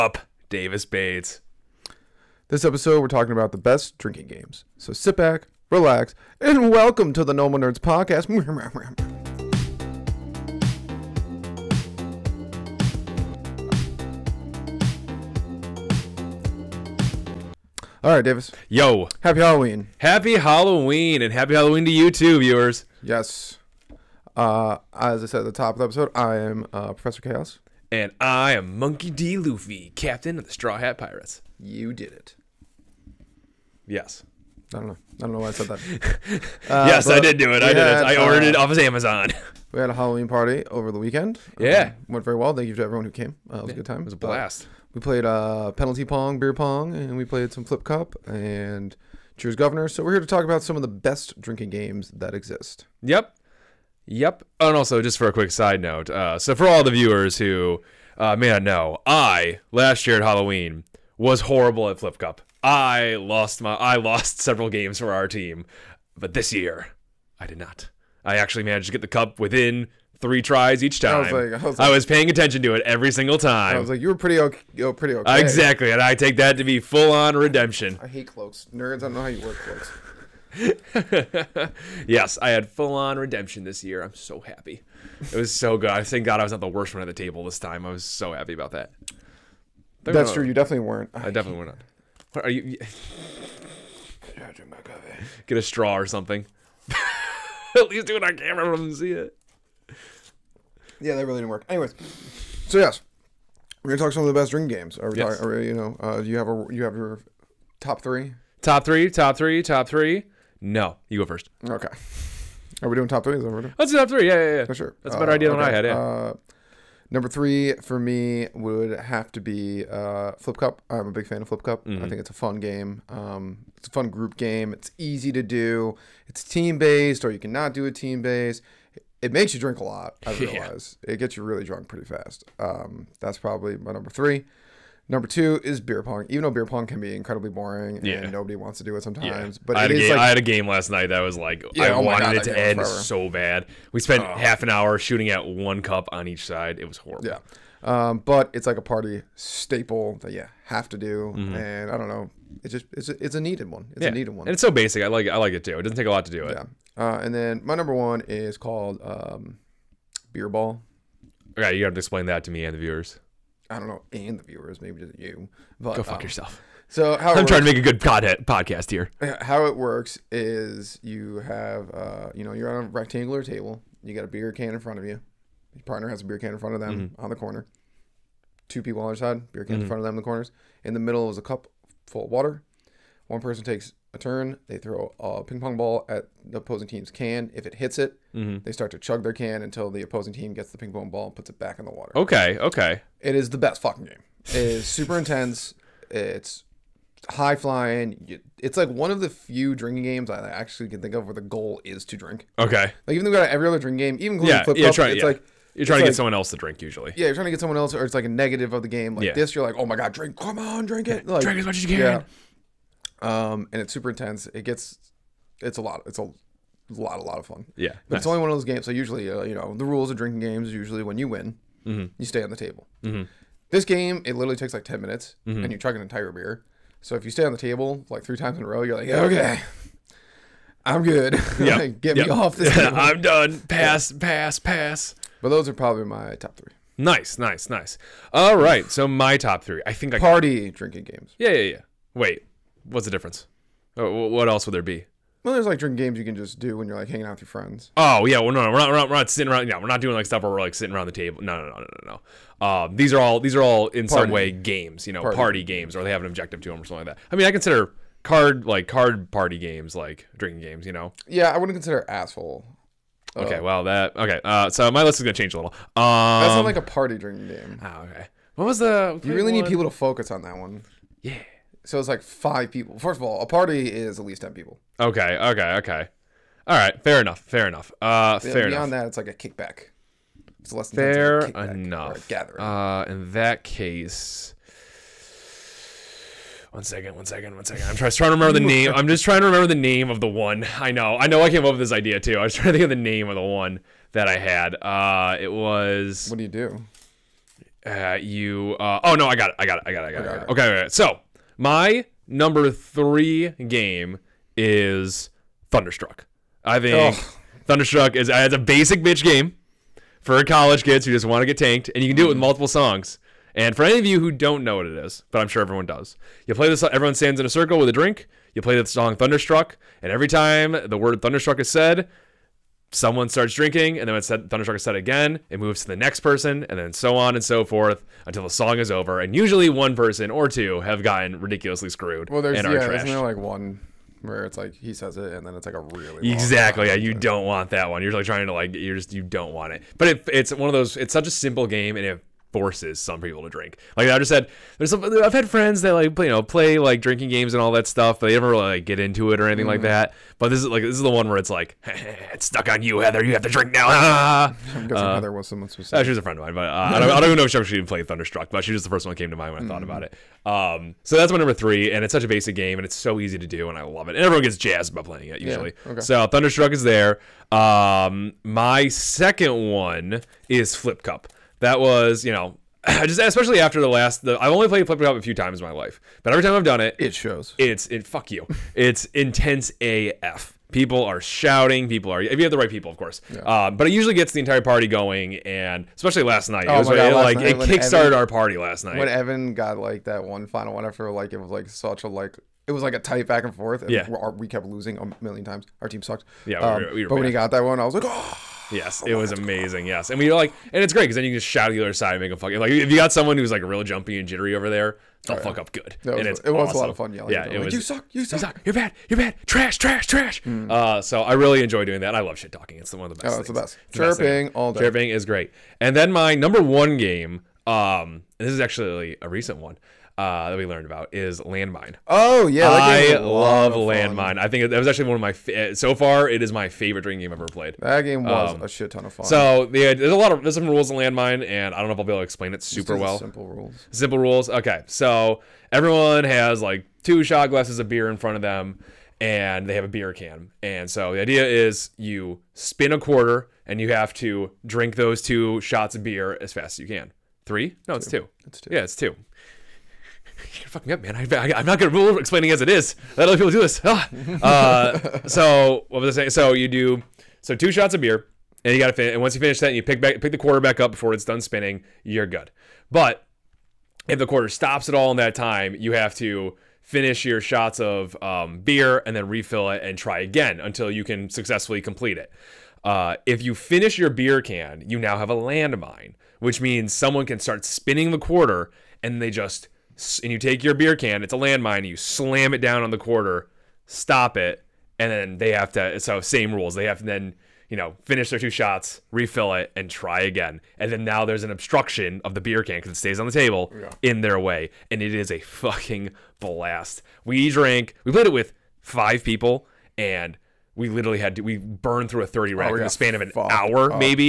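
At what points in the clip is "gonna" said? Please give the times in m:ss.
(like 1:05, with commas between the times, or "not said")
1:43, 4:25, 7:31.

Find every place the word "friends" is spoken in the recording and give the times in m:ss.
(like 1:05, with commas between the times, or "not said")
4:07, 5:45, 5:56.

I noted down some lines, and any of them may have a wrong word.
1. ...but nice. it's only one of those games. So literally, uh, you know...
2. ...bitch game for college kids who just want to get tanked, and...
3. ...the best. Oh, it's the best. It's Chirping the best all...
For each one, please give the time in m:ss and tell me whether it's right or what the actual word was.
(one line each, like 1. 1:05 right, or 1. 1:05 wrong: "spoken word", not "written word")
1. 3:38 wrong: "usually", not "literally"
2. 5:09 right
3. 6:53 right.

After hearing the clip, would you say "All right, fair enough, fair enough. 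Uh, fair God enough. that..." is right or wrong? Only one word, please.
wrong.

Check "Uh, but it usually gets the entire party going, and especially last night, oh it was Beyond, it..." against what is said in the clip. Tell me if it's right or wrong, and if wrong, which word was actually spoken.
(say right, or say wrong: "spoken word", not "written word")
wrong: "God", not "Beyond".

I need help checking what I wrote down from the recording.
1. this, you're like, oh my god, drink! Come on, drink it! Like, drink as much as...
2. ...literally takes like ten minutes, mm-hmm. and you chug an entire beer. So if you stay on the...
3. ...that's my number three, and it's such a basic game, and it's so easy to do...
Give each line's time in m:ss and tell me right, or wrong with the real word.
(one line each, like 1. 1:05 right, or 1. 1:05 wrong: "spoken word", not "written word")
1. 3:29 right
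2. 3:44 right
3. 6:01 right.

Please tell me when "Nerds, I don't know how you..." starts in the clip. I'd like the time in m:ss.
1:18.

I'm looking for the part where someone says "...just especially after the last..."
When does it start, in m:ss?
6:12.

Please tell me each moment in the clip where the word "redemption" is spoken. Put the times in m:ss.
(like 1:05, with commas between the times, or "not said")
1:17, 1:23.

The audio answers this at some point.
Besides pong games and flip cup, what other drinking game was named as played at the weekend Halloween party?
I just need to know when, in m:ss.
0:49.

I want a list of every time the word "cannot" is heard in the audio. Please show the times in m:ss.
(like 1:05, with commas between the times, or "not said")
2:07.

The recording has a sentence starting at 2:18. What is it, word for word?
nobody wants to do it sometimes, yeah.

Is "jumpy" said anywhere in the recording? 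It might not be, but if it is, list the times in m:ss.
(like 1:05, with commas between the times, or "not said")
6:43.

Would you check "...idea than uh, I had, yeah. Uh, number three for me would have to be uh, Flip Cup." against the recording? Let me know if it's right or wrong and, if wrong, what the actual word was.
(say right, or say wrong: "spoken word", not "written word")
right.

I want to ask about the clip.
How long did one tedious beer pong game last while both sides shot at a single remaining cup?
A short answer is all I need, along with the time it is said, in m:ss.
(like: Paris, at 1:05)
half an hour, at 2:24.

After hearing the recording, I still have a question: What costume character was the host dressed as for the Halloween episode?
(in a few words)
Professor Chaos.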